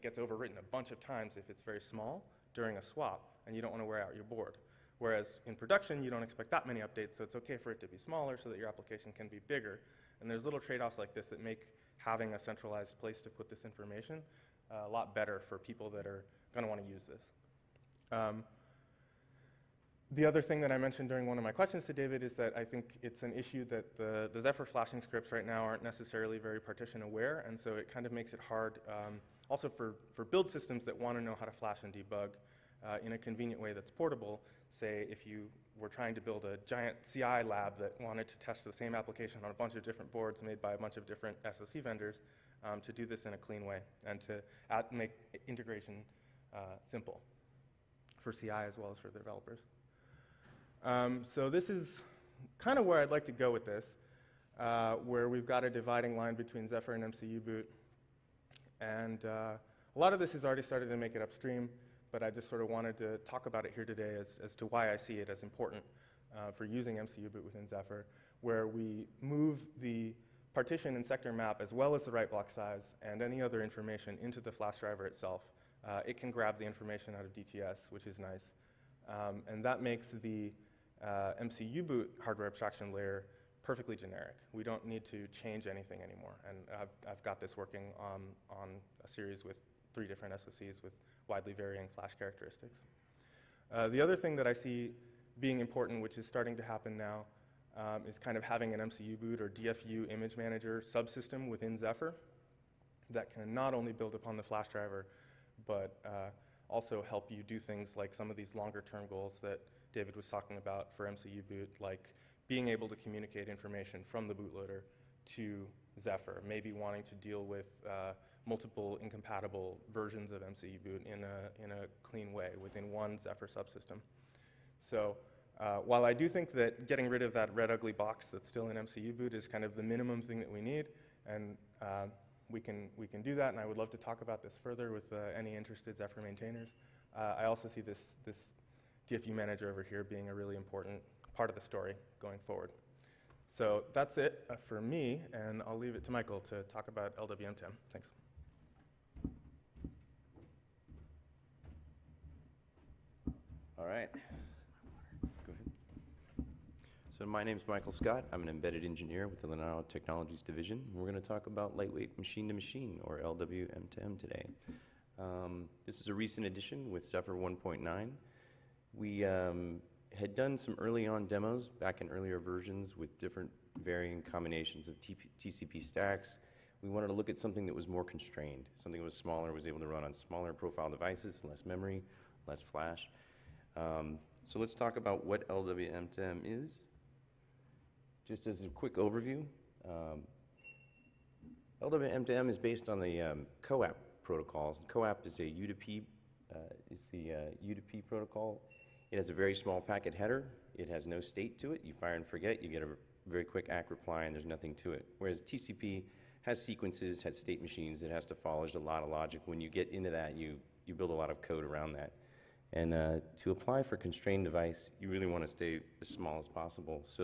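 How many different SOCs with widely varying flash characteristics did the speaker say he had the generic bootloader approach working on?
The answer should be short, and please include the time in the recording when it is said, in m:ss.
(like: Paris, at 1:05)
3, at 1:29.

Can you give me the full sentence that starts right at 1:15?
Uh, it can grab the information out of DTS, which is nice.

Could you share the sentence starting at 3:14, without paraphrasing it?
CoAP is a UDP, uh, is the uh, UDP protocol it has a very small packet header.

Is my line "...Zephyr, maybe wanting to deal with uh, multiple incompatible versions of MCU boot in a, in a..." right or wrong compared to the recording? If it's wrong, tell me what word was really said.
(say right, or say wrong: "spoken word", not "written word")
right.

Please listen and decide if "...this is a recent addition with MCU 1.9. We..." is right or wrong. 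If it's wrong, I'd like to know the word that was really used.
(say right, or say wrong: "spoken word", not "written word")
wrong: "Zephyr", not "MCU".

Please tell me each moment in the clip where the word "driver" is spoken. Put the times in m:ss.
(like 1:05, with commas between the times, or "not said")
1:14, 1:44.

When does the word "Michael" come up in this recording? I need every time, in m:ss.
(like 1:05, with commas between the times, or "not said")
2:26, 2:37.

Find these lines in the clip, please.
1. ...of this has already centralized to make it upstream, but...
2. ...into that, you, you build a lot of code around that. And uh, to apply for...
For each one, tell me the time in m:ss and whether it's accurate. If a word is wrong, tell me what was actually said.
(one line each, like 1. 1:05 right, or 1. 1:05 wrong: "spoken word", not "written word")
1. 1:00 wrong: "started", not "centralized"
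2. 3:29 right.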